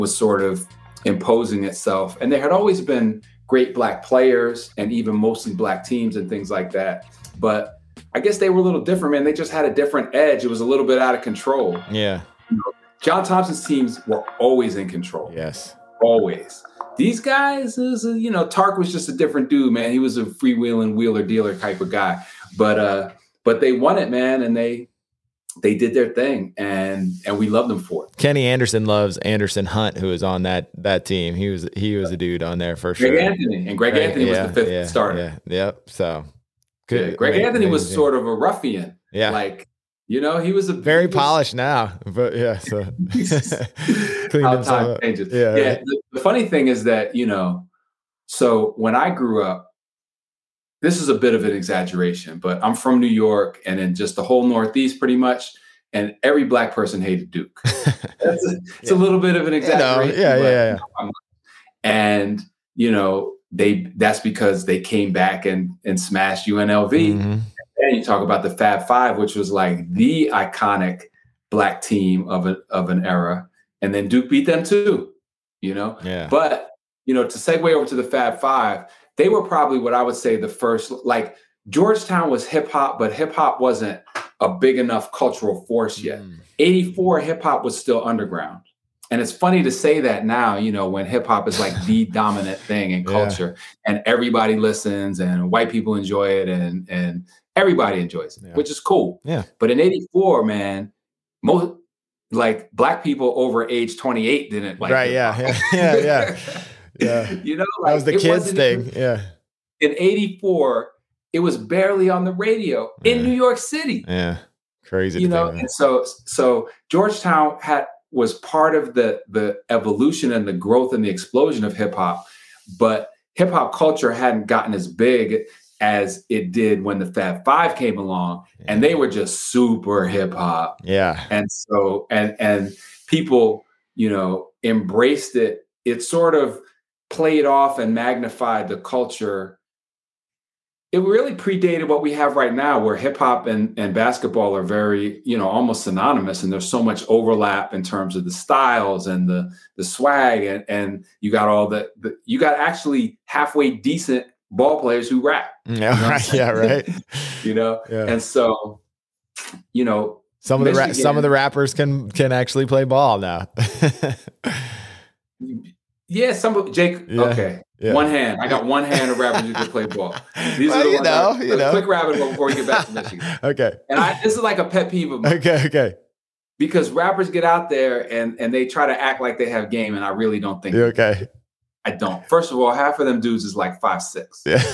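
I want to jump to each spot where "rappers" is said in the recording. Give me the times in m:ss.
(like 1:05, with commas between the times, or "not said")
2:41, 2:49, 2:56.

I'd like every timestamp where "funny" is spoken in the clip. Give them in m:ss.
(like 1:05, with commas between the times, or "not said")
0:46, 1:29.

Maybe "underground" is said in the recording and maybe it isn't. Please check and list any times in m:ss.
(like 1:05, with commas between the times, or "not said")
1:28.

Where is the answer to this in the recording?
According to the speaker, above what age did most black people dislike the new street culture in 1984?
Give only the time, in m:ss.
1:43.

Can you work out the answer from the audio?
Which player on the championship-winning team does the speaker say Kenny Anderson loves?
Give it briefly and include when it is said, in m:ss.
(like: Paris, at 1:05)
Anderson Hunt, at 0:29.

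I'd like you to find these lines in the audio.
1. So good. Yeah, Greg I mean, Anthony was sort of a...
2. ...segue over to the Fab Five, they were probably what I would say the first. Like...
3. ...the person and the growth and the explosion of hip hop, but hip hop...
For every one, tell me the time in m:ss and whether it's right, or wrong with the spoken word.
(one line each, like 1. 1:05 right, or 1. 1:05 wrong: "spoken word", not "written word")
1. 0:35 right
2. 1:17 right
3. 1:59 wrong: "evolution", not "person".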